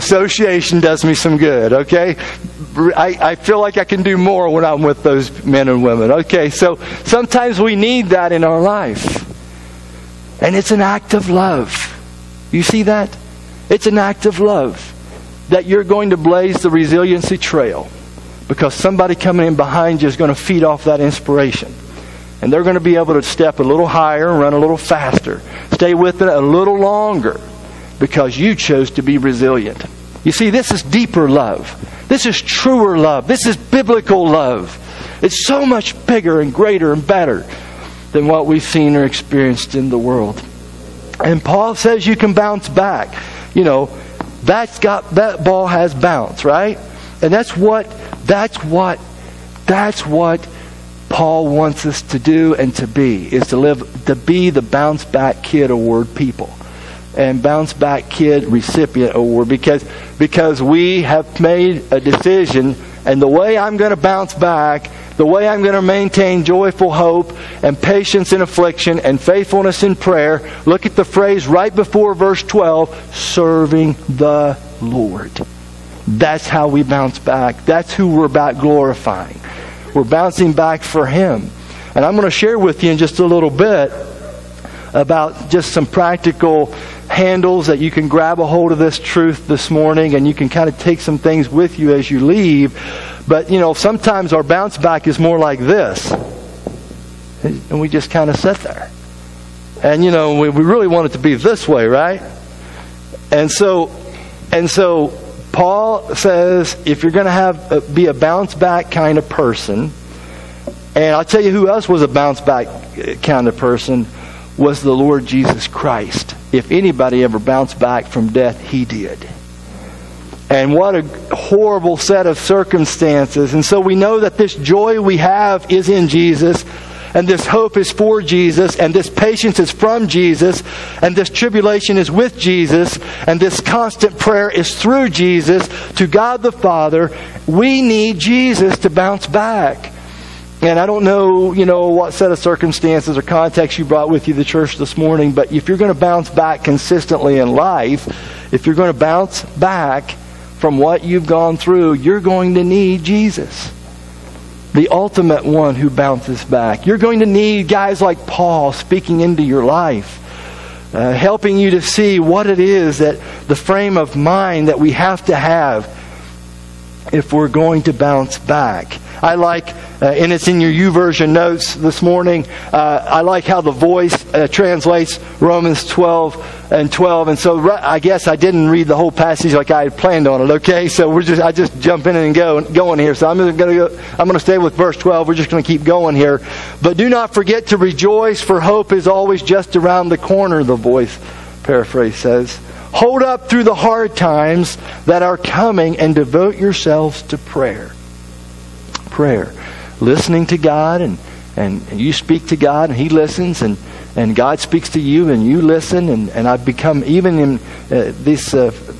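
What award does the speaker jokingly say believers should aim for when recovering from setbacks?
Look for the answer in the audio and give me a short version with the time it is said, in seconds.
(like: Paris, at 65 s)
Bounce Back Kid Recipient Award, at 57 s.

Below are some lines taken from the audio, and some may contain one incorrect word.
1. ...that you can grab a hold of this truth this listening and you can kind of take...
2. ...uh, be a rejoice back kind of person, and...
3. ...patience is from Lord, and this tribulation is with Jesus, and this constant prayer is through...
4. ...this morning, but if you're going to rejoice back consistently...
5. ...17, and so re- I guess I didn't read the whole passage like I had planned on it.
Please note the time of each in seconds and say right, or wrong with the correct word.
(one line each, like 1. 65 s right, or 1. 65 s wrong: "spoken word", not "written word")
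1. 87 s wrong: "morning", not "listening"
2. 107 s wrong: "bounce", not "rejoice"
3. 129 s wrong: "Jesus", not "Lord"
4. 144 s wrong: "bounce", not "rejoice"
5. 176 s wrong: "12", not "17".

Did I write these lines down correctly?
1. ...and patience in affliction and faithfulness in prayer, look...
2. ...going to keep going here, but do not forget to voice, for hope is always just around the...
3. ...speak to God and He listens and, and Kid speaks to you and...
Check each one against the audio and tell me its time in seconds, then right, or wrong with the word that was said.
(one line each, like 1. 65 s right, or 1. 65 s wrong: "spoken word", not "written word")
1. 67 s right
2. 185 s wrong: "rejoice", not "voice"
3. 202 s wrong: "God", not "Kid".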